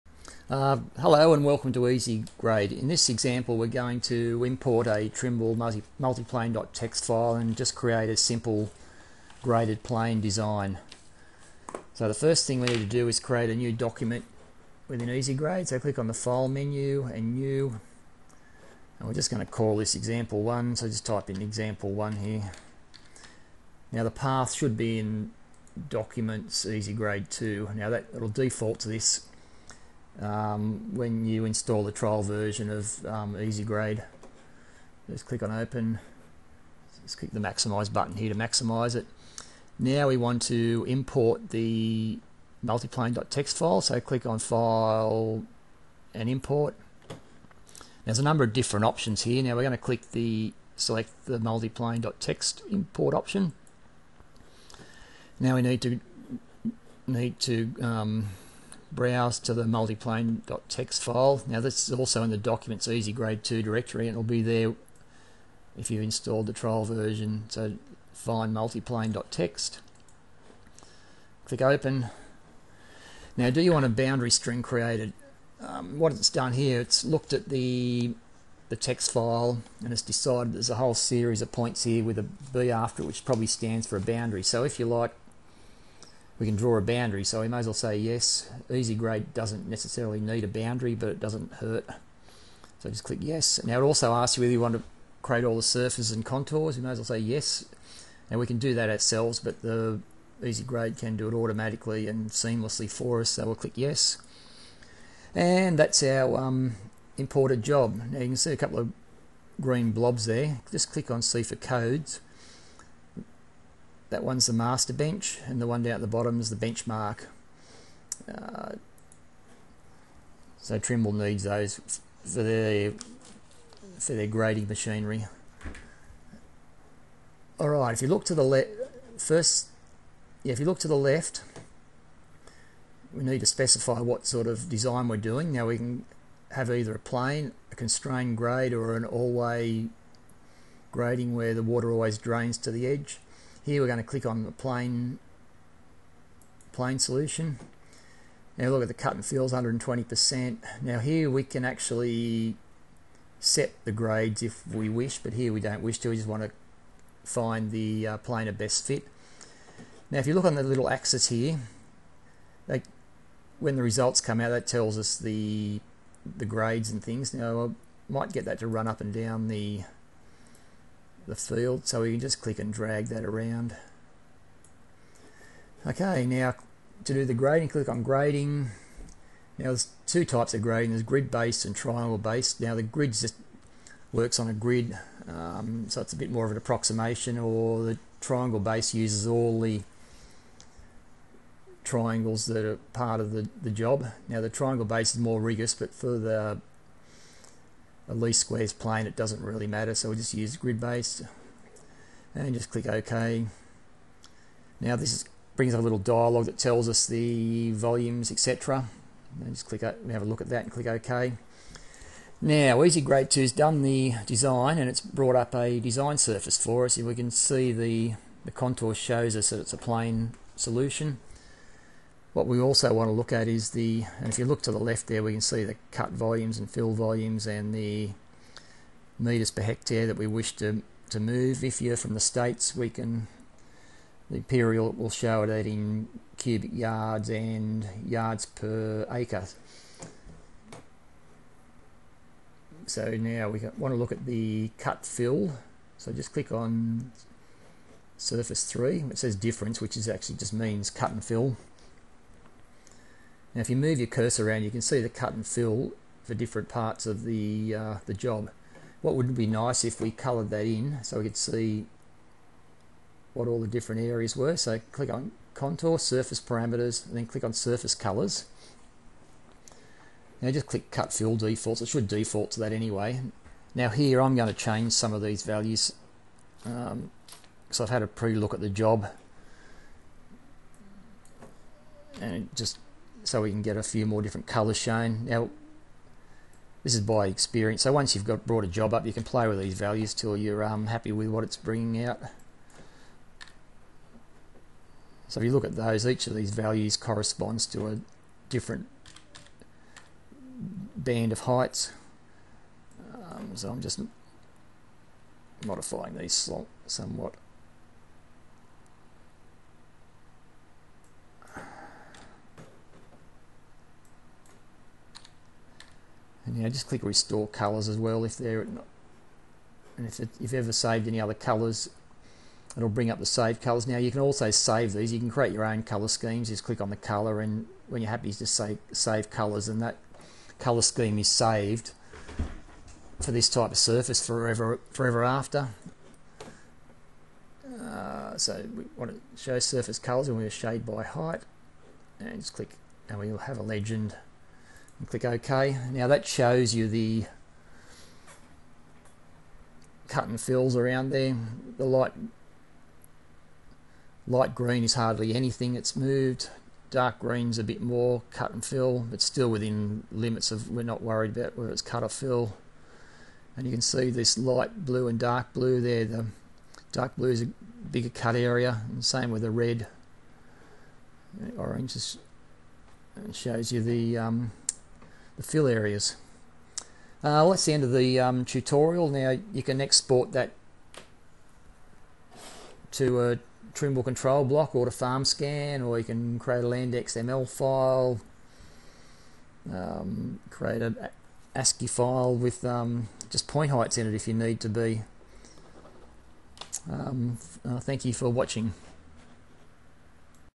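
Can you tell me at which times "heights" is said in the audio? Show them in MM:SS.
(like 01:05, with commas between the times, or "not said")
05:01, 05:41, 06:33.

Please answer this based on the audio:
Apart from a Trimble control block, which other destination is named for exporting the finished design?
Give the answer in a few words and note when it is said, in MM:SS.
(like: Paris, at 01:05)
FarmScan, at 06:24.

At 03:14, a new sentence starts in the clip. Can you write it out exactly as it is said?
Now the triangle base is more rigorous but for the least squares plane, it doesn't really matter, so we'll just use grid-based.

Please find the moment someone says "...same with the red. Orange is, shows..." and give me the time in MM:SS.
06:09.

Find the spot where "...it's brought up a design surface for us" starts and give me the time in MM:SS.
03:34.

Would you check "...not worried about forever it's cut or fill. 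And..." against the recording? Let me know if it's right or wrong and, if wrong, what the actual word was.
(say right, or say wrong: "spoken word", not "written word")
wrong: "whether", not "forever".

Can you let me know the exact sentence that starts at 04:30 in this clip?
Now just click cut fill defaults, it should default to that anyway.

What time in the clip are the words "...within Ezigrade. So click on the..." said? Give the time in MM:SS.
00:14.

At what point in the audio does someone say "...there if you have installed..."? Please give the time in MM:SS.
01:04.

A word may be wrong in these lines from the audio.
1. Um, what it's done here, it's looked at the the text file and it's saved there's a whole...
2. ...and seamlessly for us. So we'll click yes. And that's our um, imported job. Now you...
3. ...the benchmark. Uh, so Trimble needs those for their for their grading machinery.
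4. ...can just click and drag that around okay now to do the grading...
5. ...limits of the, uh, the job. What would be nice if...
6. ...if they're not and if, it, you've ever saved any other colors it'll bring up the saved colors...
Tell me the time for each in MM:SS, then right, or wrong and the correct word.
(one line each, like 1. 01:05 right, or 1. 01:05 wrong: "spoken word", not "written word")
1. 01:15 wrong: "decided", not "saved"
2. 01:42 right
3. 01:56 right
4. 02:52 right
5. 04:16 wrong: "parts", not "limits"
6. 05:18 right.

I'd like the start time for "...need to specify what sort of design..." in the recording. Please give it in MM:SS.
02:13.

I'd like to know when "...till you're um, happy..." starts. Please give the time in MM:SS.
04:50.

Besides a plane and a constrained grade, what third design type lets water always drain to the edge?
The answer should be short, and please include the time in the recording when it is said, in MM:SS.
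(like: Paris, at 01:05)
all-way grading, at 02:19.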